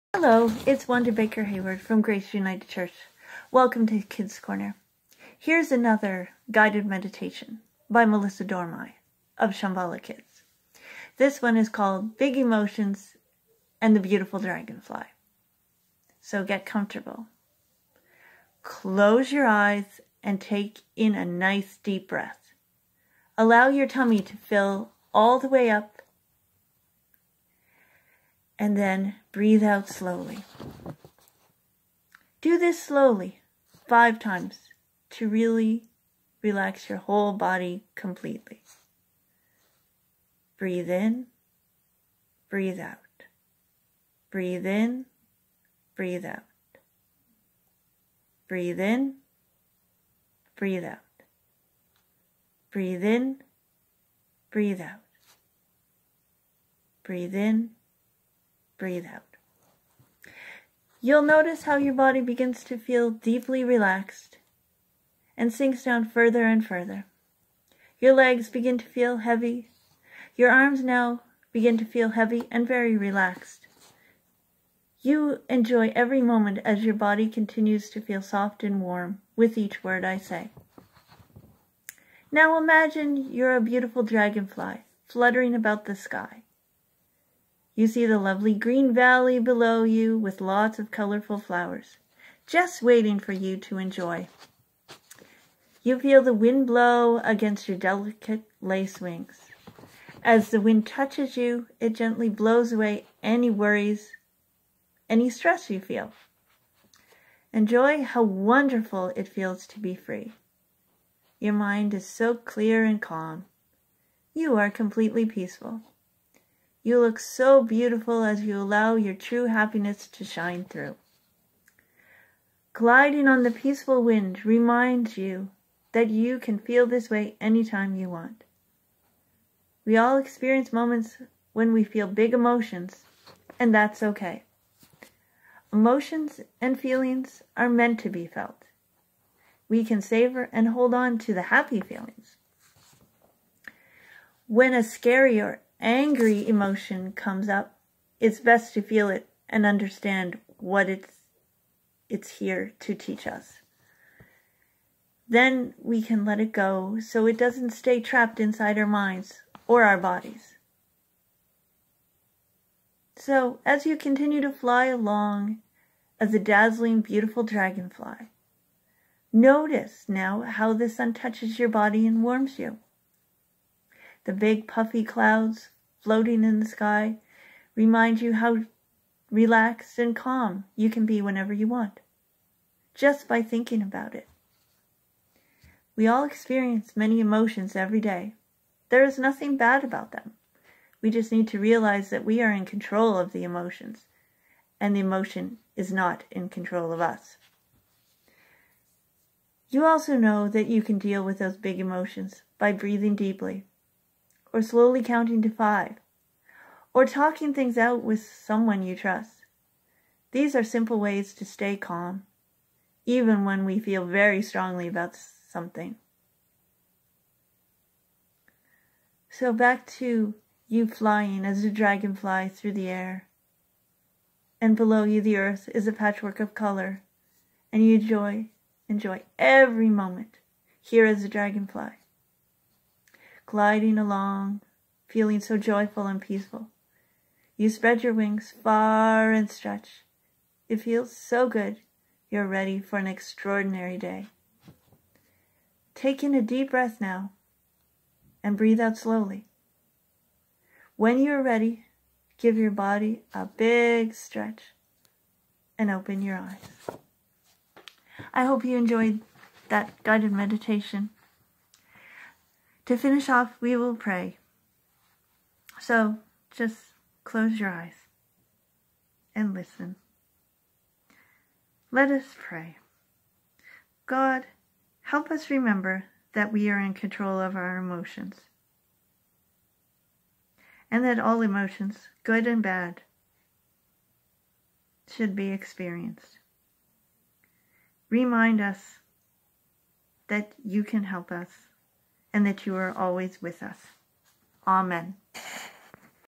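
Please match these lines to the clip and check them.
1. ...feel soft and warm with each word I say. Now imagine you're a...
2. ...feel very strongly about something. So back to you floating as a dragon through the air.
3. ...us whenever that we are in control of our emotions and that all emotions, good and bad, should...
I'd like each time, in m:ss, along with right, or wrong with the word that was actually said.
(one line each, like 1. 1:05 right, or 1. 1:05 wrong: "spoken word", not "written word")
1. 1:18 right
2. 3:33 wrong: "flying", not "floating"
3. 4:35 wrong: "remember", not "whenever".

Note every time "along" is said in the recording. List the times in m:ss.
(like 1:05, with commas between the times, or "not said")
2:44, 3:53.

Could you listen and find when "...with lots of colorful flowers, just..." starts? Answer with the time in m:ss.
1:30.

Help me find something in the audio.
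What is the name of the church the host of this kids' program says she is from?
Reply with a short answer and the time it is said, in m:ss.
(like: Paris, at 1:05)
Grace United Church, at 0:02.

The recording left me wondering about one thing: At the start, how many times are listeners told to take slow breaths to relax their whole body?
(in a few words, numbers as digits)
5.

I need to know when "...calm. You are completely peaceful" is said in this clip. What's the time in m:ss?
1:53.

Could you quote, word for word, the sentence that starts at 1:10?
Your arms now begin to feel heavy and very relaxed.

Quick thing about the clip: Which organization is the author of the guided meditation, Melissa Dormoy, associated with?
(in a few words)
Shambhala Kids.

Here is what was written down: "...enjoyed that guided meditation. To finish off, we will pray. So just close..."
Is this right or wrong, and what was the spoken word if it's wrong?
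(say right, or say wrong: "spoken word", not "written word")
right.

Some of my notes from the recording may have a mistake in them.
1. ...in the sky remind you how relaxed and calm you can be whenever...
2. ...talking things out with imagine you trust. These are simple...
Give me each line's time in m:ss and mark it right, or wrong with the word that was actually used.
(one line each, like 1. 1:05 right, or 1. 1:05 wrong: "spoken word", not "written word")
1. 2:56 right
2. 3:27 wrong: "someone", not "imagine".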